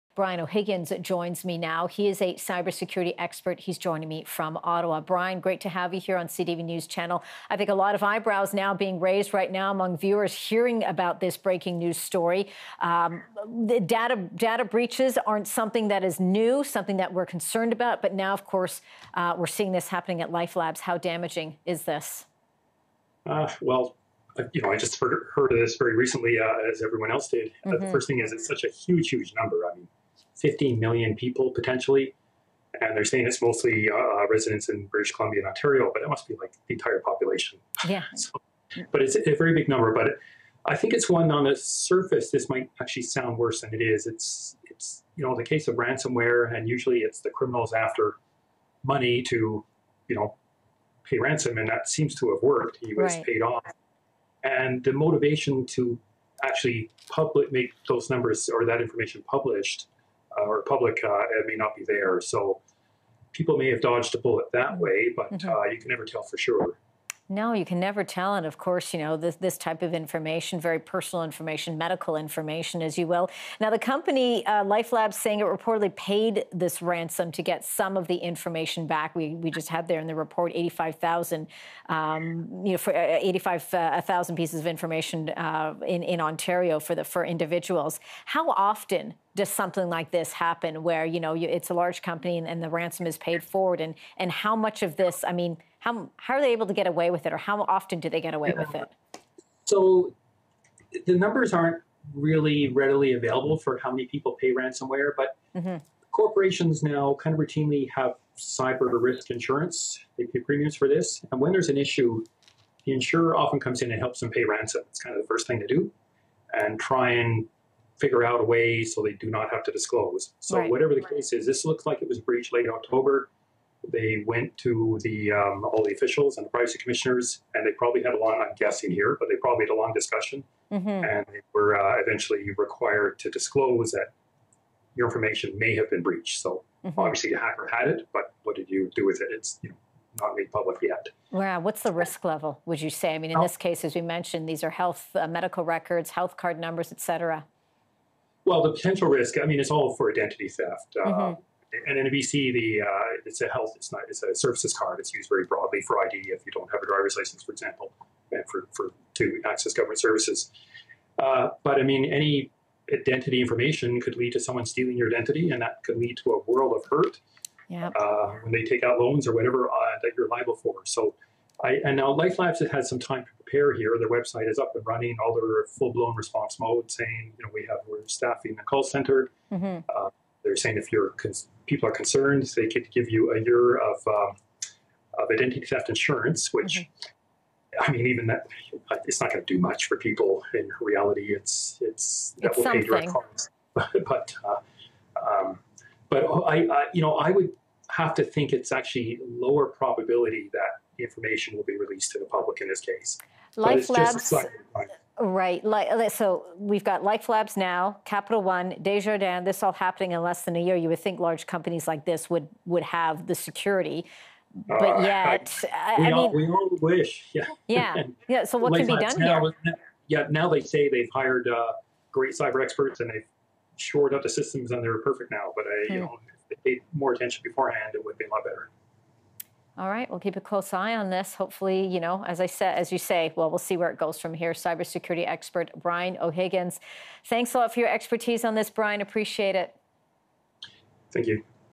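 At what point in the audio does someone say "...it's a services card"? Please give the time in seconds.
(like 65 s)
154 s.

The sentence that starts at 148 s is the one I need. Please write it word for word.
Well, the potential risk, I mean, it's all for identity theft.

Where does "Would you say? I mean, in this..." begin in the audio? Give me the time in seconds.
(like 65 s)
142 s.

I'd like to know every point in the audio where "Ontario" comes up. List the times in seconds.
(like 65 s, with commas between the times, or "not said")
35 s, 86 s.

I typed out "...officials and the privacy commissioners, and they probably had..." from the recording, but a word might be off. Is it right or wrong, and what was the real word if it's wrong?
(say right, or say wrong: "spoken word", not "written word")
right.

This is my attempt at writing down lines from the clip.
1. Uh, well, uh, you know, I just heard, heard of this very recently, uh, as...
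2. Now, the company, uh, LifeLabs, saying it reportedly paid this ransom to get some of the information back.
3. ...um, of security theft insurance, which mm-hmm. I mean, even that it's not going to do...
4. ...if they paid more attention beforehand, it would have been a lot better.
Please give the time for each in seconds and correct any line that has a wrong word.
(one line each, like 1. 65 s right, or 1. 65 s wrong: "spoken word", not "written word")
1. 23 s right
2. 73 s right
3. 184 s wrong: "identity", not "security"
4. 226 s right.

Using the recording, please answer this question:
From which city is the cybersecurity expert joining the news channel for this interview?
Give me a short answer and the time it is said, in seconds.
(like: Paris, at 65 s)
Ottawa, at 4 s.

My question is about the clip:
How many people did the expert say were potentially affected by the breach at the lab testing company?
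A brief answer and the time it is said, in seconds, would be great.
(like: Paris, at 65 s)
15 million, at 30 s.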